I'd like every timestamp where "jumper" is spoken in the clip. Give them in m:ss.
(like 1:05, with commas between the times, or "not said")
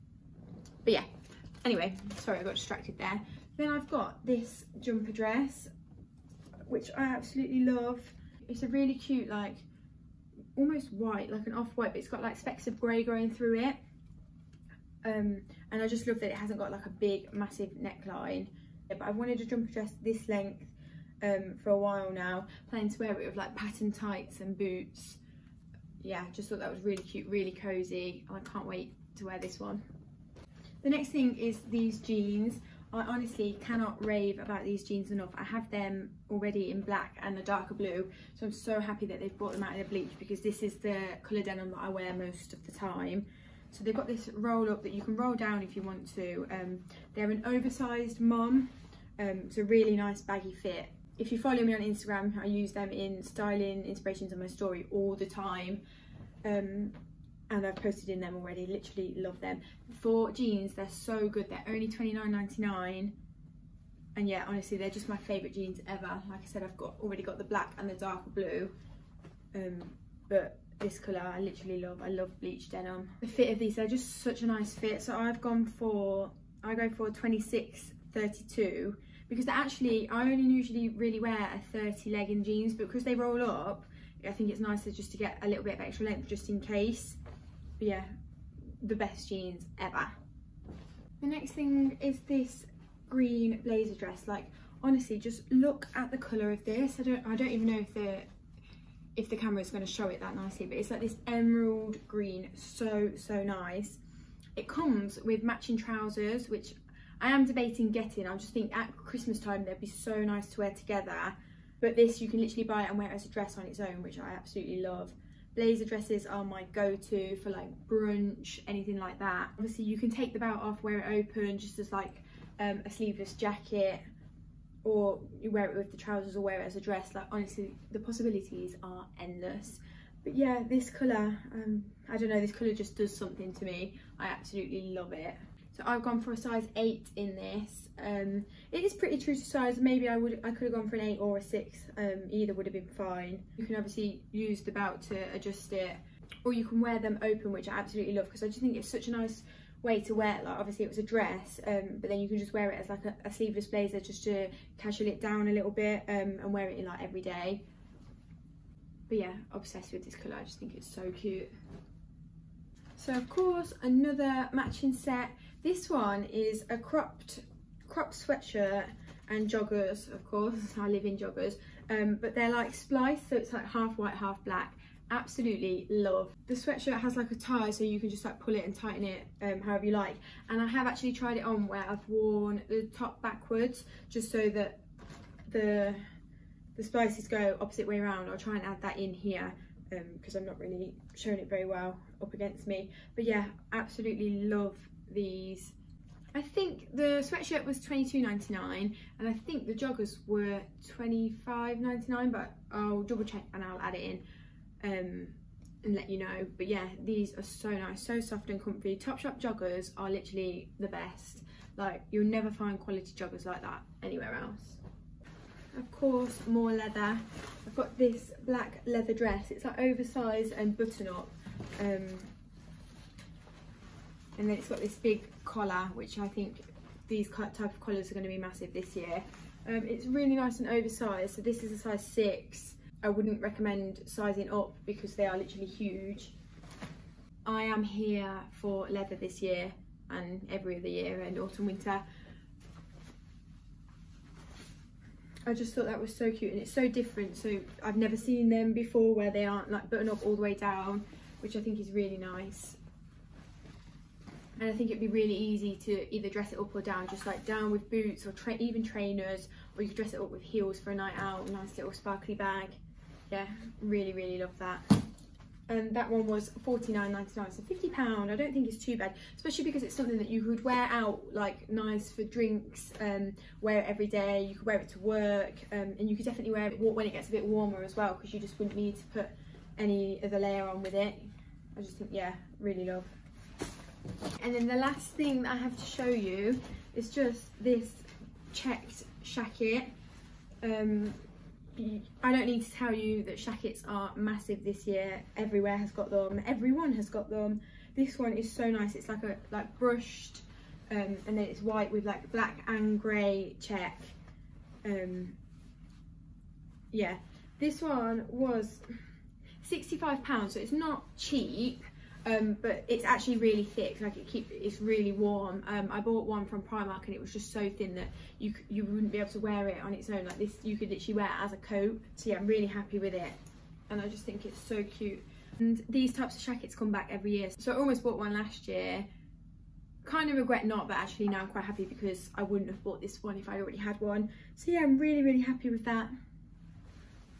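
0:04, 0:19.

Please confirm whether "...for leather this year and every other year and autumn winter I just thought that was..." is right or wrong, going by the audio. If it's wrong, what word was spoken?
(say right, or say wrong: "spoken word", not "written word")
right.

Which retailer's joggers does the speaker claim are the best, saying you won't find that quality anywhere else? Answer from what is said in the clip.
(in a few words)
Topshop.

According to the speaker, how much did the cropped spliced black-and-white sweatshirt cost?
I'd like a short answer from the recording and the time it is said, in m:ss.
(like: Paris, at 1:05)
£22.99, at 3:17.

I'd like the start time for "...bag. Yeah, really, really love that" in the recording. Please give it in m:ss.
4:22.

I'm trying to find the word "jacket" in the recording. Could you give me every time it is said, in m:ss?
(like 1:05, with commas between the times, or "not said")
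2:03, 5:26.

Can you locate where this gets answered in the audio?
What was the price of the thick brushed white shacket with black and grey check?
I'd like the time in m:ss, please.
5:09.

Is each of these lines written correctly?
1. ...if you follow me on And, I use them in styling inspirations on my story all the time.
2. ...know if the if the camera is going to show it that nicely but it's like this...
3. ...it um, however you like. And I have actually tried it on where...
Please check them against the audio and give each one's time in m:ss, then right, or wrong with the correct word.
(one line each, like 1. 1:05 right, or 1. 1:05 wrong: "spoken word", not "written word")
1. 0:51 wrong: "Instagram", not "And"
2. 1:37 right
3. 2:59 right.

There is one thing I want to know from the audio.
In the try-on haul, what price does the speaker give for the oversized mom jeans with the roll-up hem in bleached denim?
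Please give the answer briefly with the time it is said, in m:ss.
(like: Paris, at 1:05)
£29.99, at 1:01.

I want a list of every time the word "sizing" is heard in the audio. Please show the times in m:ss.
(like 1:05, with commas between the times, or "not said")
3:54.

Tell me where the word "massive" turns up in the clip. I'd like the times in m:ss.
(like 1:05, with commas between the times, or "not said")
0:17, 3:48, 4:54.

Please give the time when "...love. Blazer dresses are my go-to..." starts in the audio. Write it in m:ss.
1:54.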